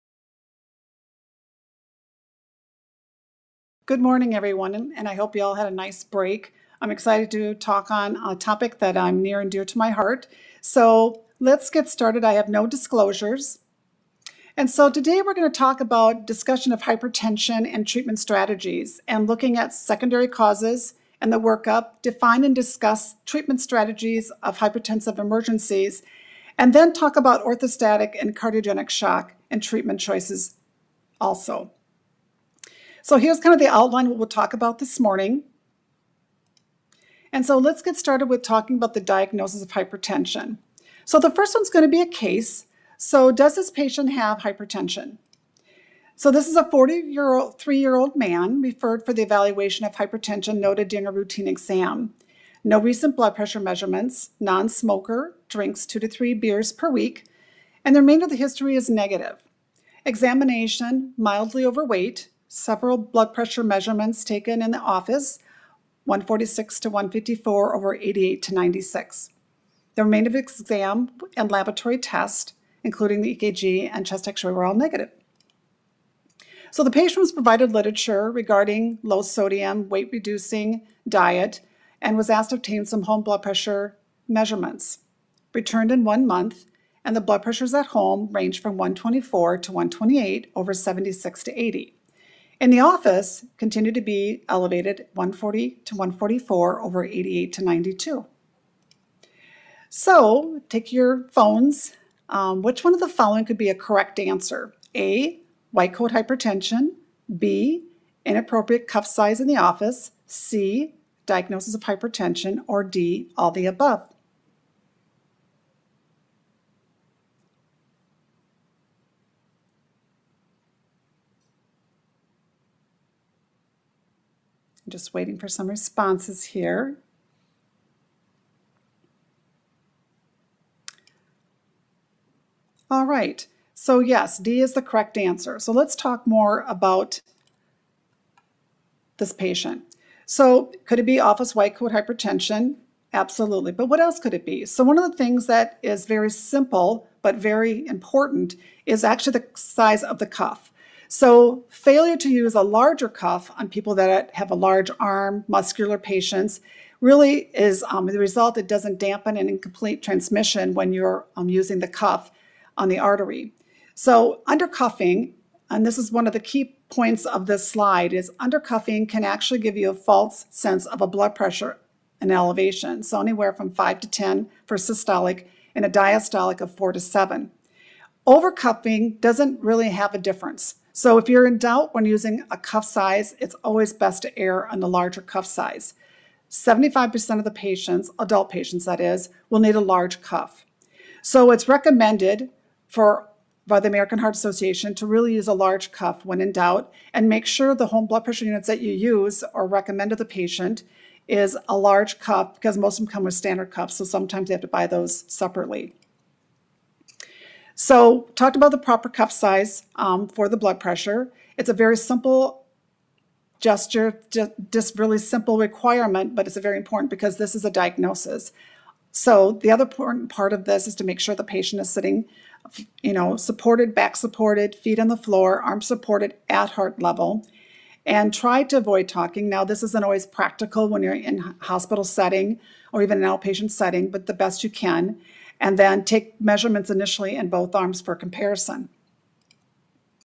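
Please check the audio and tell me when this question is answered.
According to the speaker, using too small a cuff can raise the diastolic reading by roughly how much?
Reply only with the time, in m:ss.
2:56.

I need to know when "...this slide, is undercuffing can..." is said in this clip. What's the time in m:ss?
2:47.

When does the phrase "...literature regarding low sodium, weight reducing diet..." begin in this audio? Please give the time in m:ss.
1:17.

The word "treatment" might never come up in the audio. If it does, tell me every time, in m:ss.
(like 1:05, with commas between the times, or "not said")
0:17, 0:23, 0:29.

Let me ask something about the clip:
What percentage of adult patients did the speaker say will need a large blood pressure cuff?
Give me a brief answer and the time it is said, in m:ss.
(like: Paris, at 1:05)
75%, at 3:06.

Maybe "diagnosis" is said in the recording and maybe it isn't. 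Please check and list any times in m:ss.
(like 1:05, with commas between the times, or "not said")
0:39, 1:51, 3:37.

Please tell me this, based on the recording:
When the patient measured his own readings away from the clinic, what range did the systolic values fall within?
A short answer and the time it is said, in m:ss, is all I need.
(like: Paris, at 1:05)
124 to 128, at 1:28.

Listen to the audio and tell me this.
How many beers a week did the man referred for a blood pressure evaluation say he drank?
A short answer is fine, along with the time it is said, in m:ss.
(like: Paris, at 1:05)
2 to 3, at 0:55.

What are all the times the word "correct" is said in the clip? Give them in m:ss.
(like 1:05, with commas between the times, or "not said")
1:43, 2:14.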